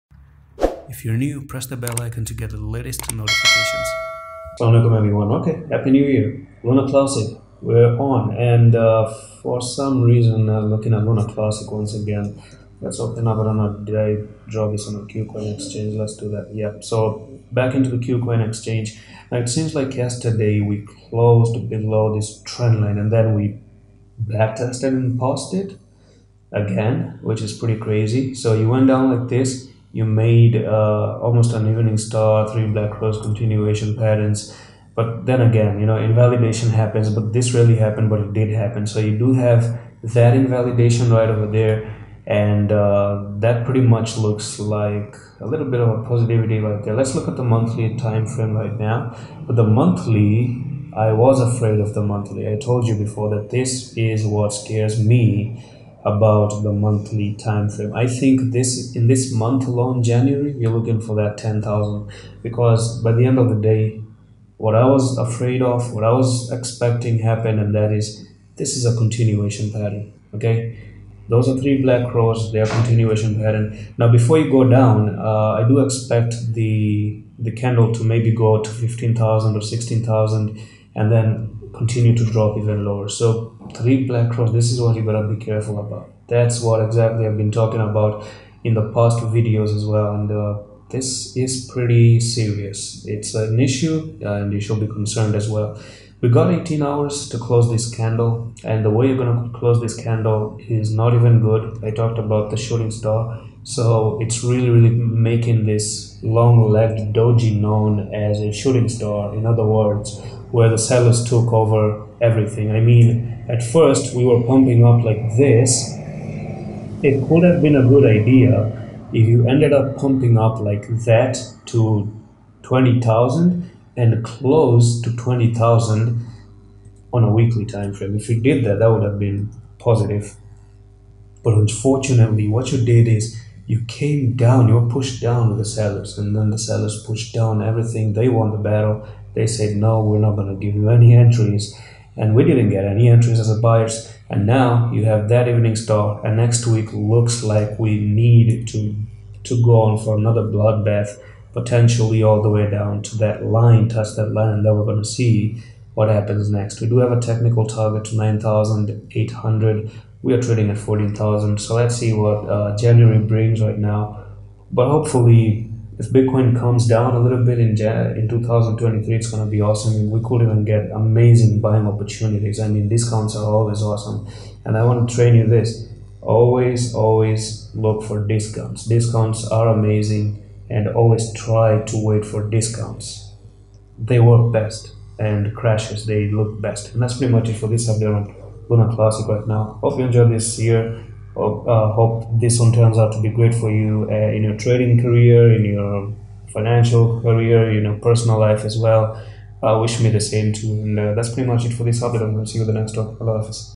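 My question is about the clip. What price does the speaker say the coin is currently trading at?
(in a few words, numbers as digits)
14,000.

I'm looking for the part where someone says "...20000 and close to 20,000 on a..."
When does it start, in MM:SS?
02:02.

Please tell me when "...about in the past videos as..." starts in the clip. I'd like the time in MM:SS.
01:27.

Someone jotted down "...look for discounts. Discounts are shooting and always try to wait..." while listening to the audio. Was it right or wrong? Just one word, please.
wrong.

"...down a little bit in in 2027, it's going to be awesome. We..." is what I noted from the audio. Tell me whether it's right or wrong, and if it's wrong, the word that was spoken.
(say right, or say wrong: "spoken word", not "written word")
wrong: "2023", not "2027".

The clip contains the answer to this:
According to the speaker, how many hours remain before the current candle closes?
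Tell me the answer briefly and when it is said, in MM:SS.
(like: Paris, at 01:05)
18, at 01:36.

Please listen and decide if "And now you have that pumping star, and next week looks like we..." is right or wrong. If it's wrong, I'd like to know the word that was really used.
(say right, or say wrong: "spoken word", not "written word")
wrong: "evening", not "pumping".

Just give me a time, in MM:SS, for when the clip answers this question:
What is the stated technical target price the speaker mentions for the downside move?
02:38.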